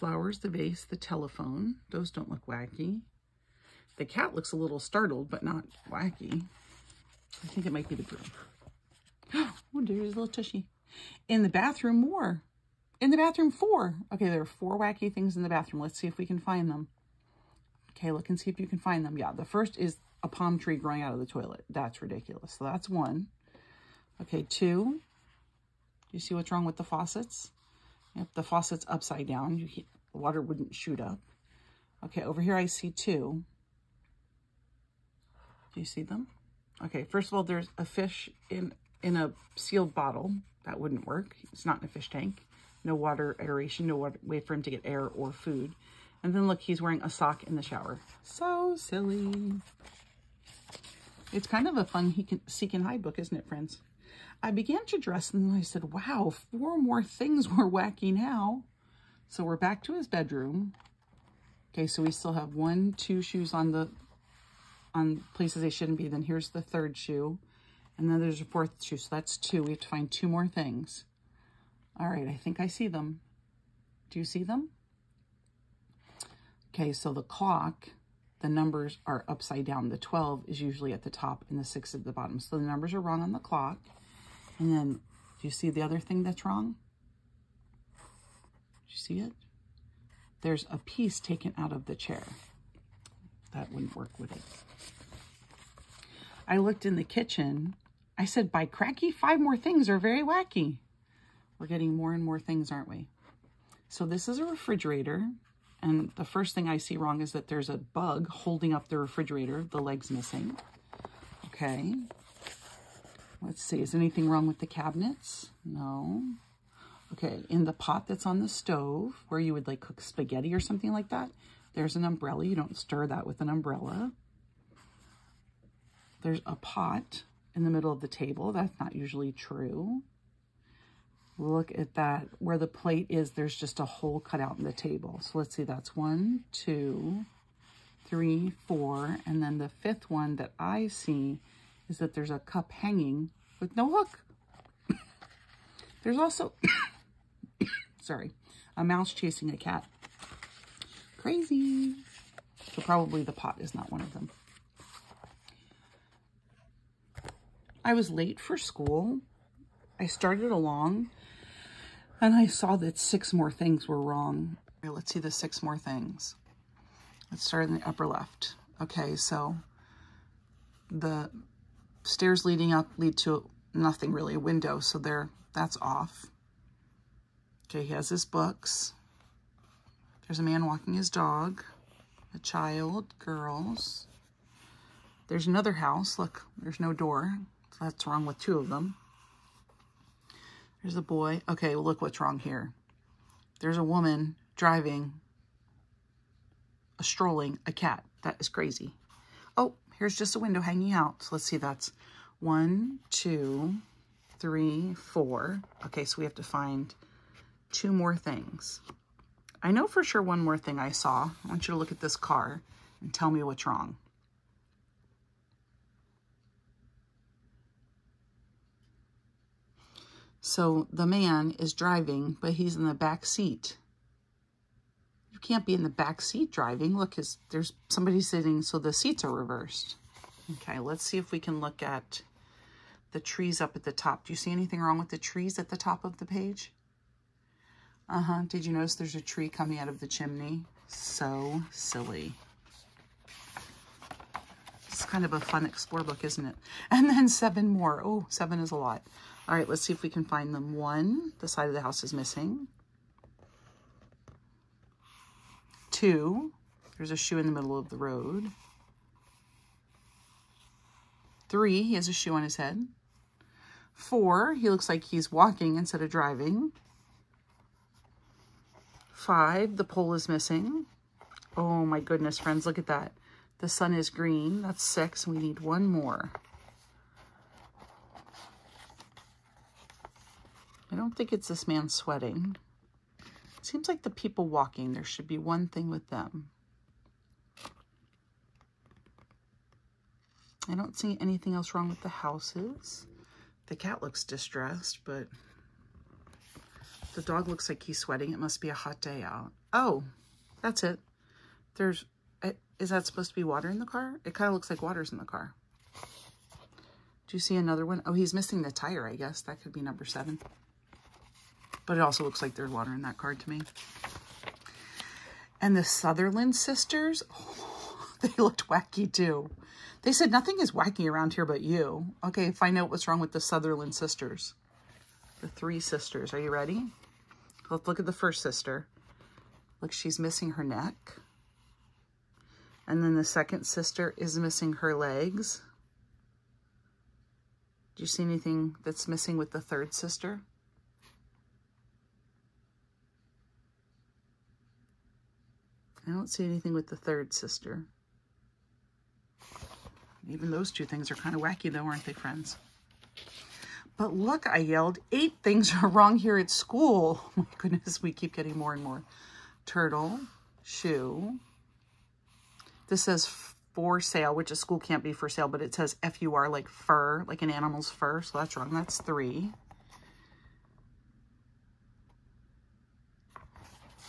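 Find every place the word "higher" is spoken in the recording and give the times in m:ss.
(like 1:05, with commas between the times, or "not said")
not said.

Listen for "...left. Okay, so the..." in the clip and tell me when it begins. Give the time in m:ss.
2:48.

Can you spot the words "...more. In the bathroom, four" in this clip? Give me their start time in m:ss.
0:11.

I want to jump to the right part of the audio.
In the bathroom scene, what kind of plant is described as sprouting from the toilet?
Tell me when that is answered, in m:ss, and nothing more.
0:20.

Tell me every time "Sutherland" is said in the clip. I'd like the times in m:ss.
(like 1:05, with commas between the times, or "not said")
5:15, 5:23.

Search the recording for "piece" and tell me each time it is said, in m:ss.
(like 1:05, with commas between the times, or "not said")
1:30.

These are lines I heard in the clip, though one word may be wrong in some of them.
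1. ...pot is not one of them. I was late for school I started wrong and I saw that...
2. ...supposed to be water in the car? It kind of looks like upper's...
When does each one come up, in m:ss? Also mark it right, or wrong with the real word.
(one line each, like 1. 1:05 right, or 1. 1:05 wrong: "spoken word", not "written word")
1. 2:33 wrong: "along", not "wrong"
2. 5:03 wrong: "water", not "upper".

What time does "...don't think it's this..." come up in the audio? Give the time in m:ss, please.
4:40.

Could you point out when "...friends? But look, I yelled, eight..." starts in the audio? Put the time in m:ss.
5:52.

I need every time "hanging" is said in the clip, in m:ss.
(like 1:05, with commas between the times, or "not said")
2:22, 3:20.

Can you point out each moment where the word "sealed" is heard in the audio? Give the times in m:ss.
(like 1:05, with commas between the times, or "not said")
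0:39.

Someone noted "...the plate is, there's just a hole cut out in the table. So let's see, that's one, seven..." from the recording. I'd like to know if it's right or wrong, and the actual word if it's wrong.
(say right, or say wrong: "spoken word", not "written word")
wrong: "two", not "seven".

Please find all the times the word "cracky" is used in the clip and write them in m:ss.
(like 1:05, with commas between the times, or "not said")
1:38.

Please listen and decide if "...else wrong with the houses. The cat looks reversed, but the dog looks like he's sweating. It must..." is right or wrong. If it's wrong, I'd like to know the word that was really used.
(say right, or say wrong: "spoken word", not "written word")
wrong: "distressed", not "reversed".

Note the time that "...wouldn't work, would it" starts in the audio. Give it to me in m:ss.
1:33.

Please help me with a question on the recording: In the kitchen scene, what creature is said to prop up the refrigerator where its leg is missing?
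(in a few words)
a bug.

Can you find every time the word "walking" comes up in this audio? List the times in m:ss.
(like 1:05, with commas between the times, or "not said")
3:00, 4:25, 4:44.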